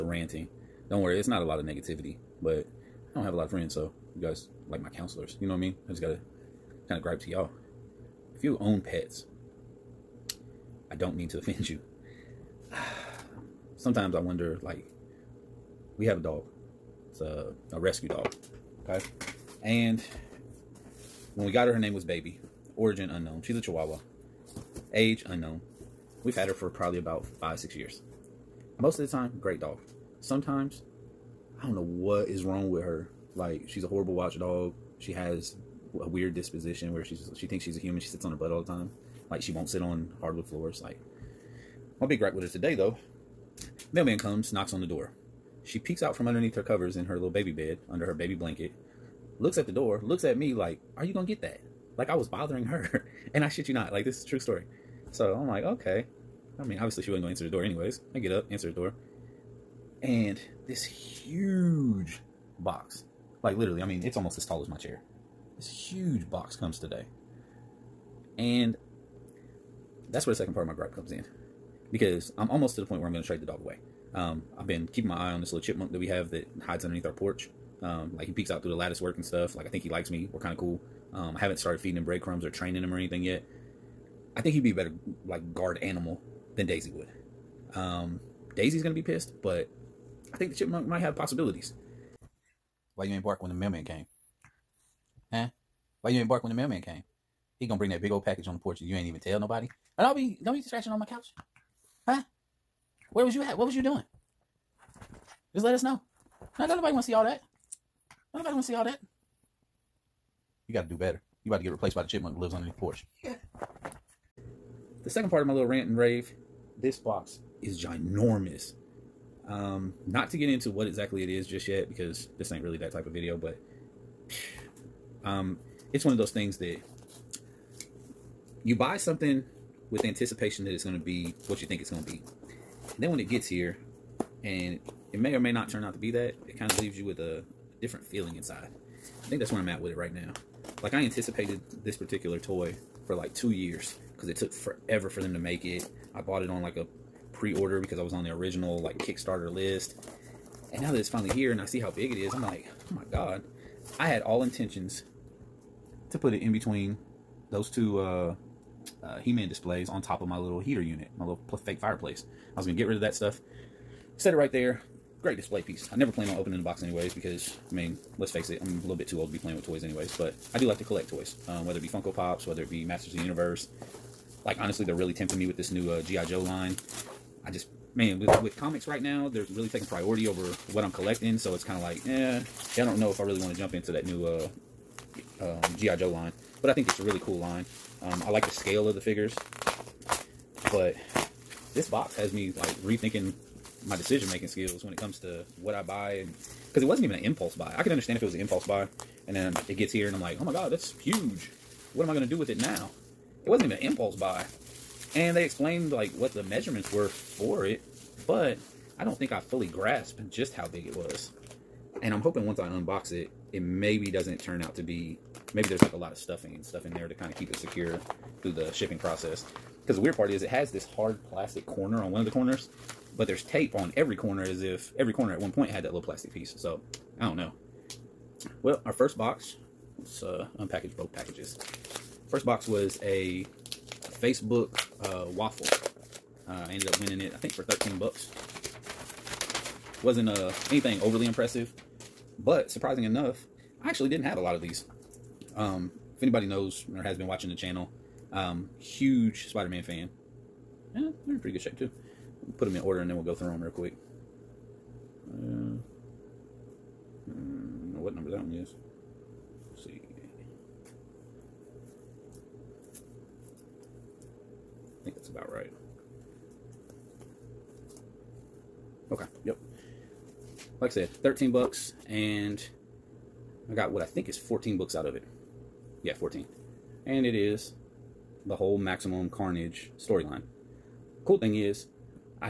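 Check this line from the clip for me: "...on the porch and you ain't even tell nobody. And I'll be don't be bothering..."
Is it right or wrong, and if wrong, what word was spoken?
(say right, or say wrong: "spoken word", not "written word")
wrong: "scratching", not "bothering".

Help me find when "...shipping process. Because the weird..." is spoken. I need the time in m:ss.
3:38.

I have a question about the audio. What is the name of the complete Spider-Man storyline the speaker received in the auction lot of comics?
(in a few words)
Maximum Carnage.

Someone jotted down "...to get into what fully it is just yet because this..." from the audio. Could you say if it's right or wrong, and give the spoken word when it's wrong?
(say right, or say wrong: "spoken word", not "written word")
wrong: "exactly", not "fully".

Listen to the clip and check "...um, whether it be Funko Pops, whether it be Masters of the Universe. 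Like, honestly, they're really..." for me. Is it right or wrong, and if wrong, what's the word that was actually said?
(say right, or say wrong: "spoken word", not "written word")
right.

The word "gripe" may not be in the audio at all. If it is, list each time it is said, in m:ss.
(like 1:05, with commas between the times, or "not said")
0:07, 0:42, 1:10.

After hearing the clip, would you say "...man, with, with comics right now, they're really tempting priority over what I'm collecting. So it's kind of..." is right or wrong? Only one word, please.
wrong.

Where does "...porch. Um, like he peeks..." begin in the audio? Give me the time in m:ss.
1:17.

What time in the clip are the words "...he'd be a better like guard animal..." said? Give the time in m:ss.
1:24.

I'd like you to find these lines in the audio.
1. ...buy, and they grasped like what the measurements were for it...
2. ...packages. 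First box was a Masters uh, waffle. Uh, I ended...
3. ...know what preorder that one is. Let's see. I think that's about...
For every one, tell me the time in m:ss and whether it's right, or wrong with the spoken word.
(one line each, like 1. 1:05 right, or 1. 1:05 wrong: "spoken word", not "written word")
1. 3:24 wrong: "explained", not "grasped"
2. 3:51 wrong: "Facebook", not "Masters"
3. 4:17 wrong: "number", not "preorder".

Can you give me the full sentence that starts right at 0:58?
I get up, answer the door.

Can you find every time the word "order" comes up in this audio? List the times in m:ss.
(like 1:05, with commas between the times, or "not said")
2:27, 4:12.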